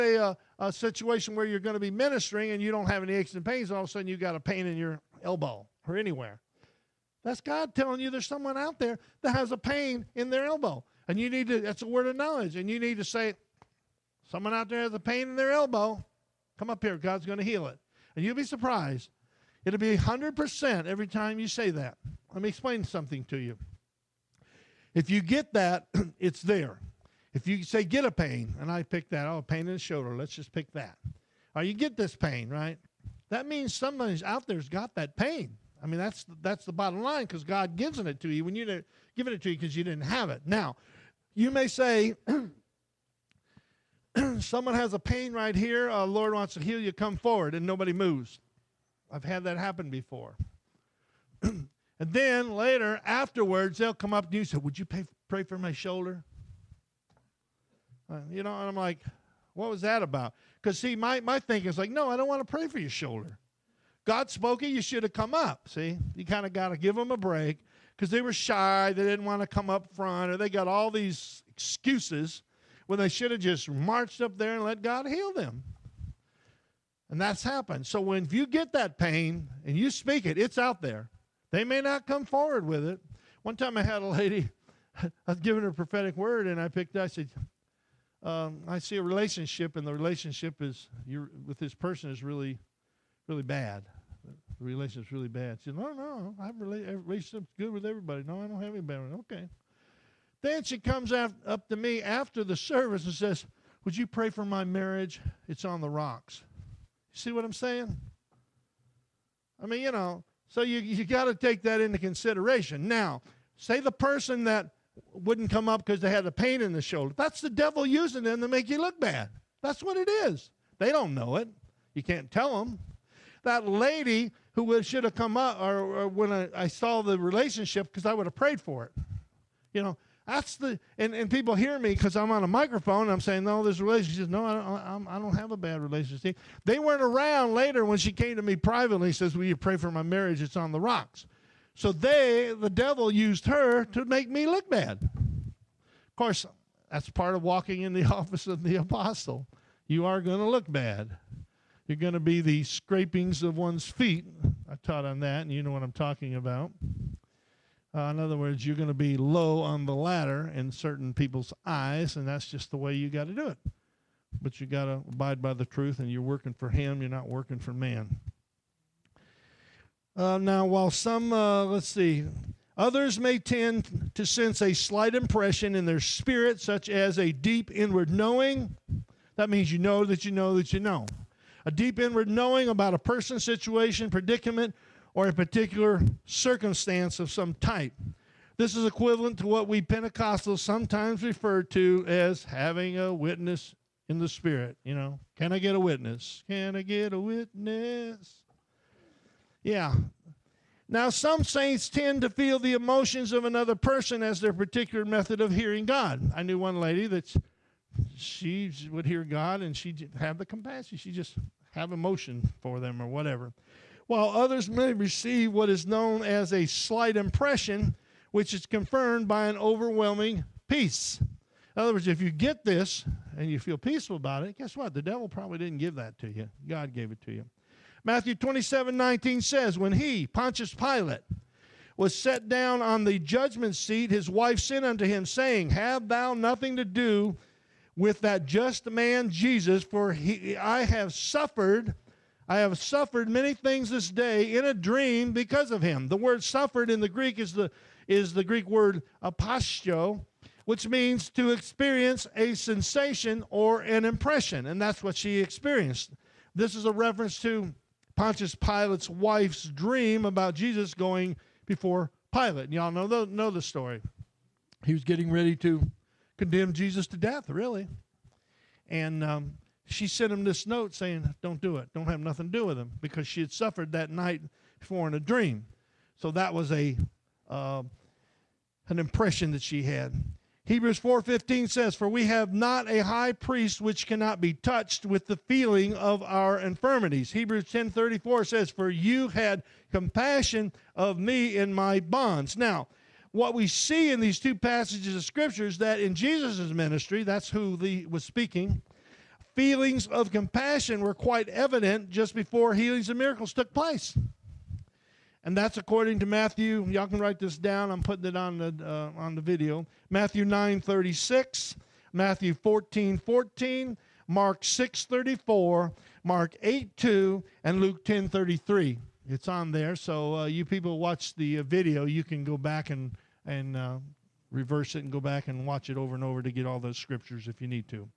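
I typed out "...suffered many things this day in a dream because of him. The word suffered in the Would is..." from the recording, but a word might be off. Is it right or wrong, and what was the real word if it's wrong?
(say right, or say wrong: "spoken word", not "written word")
wrong: "Greek", not "Would".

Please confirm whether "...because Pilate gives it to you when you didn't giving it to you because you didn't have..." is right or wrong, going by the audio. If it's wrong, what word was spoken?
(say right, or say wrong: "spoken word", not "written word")
wrong: "God", not "Pilate".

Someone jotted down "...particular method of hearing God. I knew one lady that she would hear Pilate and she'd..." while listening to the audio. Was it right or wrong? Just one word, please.
wrong.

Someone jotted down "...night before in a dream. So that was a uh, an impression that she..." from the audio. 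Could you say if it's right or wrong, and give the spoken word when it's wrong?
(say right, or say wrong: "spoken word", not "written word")
right.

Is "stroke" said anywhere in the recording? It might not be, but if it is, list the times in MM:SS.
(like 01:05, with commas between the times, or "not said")
not said.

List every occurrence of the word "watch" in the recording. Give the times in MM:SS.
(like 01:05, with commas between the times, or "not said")
05:20, 05:25.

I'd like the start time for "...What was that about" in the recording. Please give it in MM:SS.
00:59.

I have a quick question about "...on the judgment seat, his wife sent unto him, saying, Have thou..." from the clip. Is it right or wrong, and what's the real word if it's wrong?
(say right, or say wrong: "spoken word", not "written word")
right.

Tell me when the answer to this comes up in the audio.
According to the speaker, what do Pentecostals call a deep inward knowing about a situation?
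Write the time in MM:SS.
03:12.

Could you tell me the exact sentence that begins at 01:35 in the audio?
She said, No, no, I have a relationship's good with everybody.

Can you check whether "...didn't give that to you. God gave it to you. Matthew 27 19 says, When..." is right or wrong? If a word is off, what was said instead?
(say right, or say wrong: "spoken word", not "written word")
right.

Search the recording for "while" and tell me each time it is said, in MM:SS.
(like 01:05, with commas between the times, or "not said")
02:50, 03:34.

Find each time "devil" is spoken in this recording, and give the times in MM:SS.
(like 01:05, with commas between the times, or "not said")
01:57, 02:22, 03:45.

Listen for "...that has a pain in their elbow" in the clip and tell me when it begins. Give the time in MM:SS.
00:09.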